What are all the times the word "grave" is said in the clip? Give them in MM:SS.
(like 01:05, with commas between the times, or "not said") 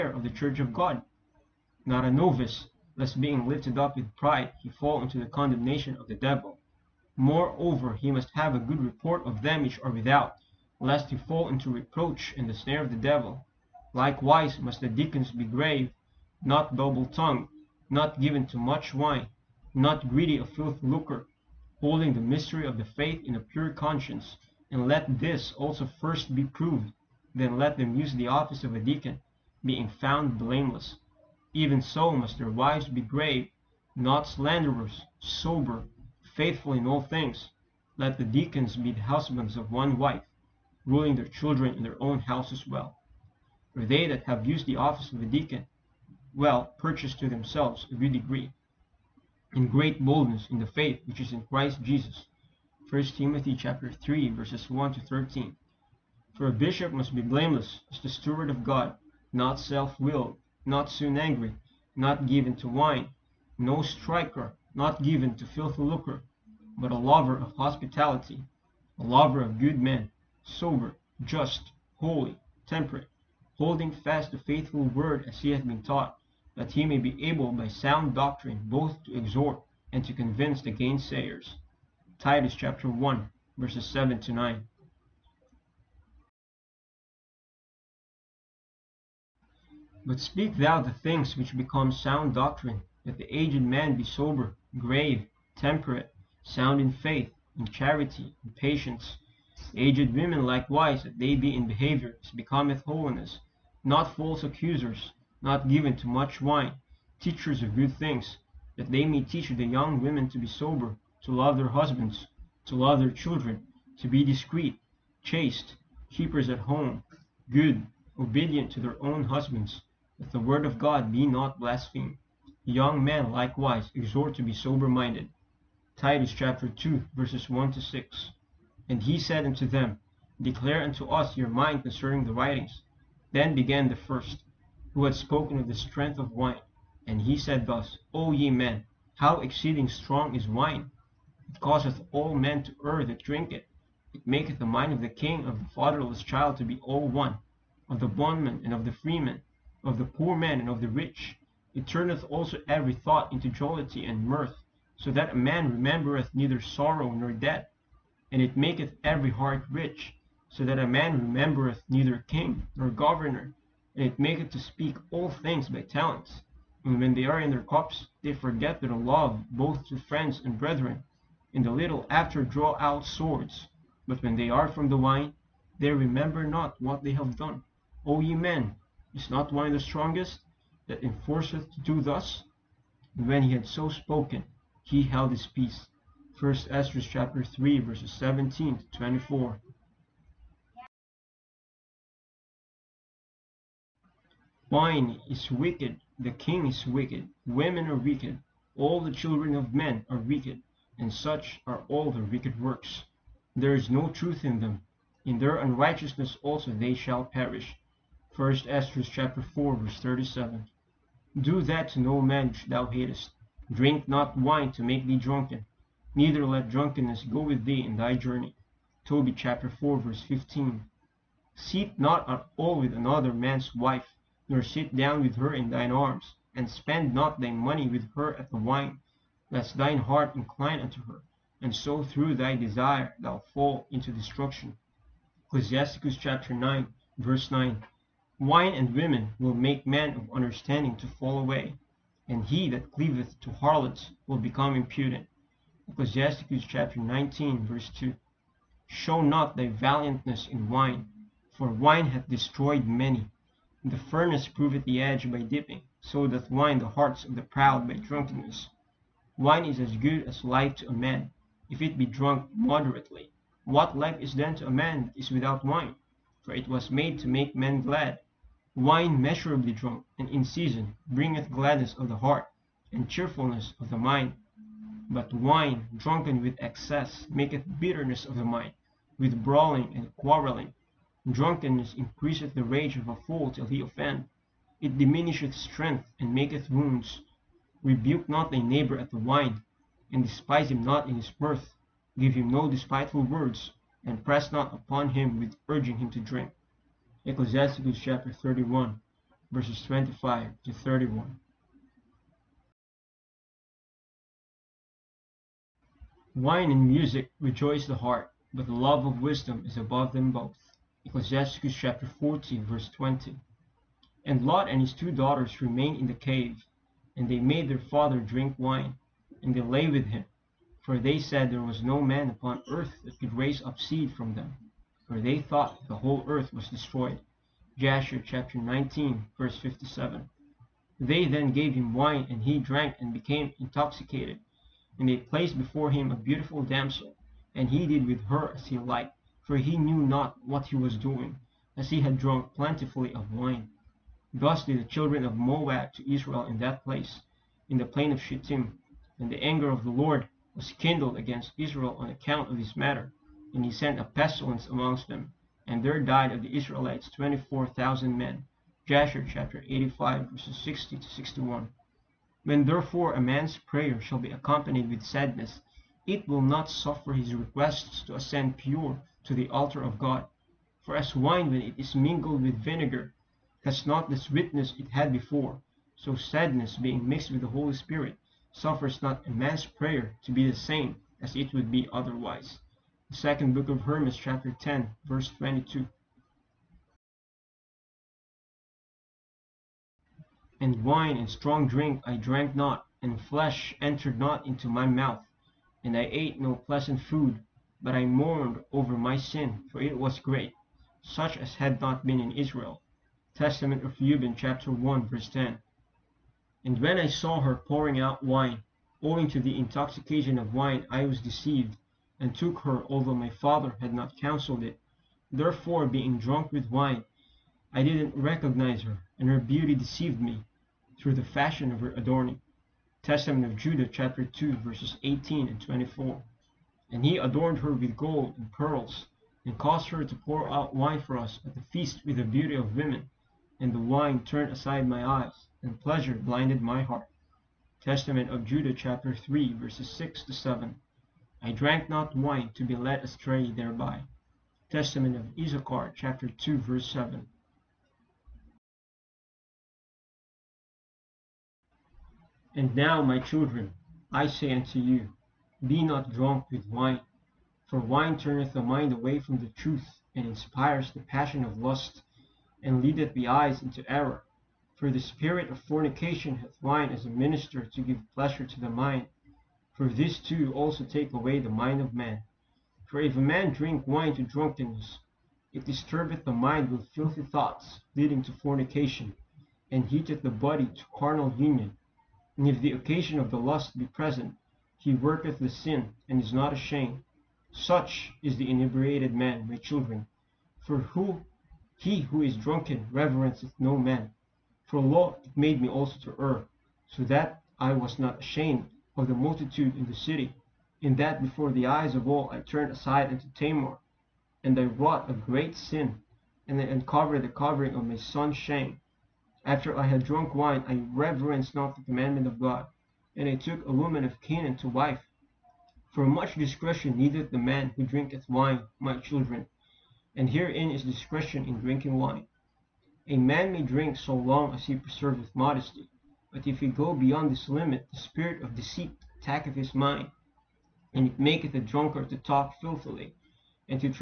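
00:15, 00:33, 01:34.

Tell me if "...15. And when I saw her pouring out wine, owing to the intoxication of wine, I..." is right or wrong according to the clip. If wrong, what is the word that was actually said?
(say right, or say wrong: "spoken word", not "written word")
wrong: "10", not "15".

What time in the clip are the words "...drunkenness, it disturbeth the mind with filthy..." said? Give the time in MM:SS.
07:54.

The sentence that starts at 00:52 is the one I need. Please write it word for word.
1 Timothy chapter 3 verses 1 to 13.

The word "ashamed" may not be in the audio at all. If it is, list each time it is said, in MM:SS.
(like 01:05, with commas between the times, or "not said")
08:06, 08:18.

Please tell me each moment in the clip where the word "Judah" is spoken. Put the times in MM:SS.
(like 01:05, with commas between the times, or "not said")
07:03, 07:18.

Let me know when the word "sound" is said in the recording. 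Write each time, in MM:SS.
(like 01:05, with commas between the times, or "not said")
01:17, 01:31, 01:36.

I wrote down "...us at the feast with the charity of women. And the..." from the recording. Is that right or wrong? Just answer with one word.
wrong.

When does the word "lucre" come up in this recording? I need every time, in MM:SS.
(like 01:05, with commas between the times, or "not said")
00:20, 01:05.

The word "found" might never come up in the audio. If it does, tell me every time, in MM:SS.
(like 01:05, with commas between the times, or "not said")
00:29.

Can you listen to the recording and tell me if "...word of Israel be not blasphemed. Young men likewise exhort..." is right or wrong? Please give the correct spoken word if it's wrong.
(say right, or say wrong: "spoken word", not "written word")
wrong: "God", not "Israel".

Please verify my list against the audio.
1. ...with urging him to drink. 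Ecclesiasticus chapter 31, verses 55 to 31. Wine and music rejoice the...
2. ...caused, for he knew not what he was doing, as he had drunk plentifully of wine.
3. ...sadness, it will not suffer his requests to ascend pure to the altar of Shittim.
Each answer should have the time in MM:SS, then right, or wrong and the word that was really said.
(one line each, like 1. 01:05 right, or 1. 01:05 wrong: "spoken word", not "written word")
1. 04:55 wrong: "25", not "55"
2. 05:38 wrong: "liked", not "caused"
3. 06:05 wrong: "God", not "Shittim".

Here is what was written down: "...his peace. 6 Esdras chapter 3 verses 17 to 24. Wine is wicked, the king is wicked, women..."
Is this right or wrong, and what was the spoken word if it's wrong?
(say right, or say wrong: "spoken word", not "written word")
wrong: "1", not "6".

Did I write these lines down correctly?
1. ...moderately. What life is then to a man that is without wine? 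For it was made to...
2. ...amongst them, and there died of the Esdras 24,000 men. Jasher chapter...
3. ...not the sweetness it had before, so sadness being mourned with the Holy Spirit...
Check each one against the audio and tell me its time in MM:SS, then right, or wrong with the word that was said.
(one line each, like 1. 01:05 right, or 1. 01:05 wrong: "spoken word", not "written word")
1. 04:22 right
2. 05:54 wrong: "Israelites", not "Esdras"
3. 06:13 wrong: "mixed", not "mourned".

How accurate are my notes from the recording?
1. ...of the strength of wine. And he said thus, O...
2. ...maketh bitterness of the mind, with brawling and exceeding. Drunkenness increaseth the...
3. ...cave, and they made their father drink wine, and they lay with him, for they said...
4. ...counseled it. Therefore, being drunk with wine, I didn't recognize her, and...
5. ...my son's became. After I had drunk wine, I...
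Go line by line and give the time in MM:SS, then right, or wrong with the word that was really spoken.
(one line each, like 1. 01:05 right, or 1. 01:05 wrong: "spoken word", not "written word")
1. 02:15 right
2. 04:37 wrong: "quarreling", not "exceeding"
3. 05:16 right
4. 06:54 right
5. 08:27 wrong: "shame", not "became".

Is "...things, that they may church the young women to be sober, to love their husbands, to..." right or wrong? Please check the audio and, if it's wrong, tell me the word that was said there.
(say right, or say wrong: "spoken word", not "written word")
wrong: "teach", not "church".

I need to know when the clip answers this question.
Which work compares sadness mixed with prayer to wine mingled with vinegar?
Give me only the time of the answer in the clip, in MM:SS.
06:23.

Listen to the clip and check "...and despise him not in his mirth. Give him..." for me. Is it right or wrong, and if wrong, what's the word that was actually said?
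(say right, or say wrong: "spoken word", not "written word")
right.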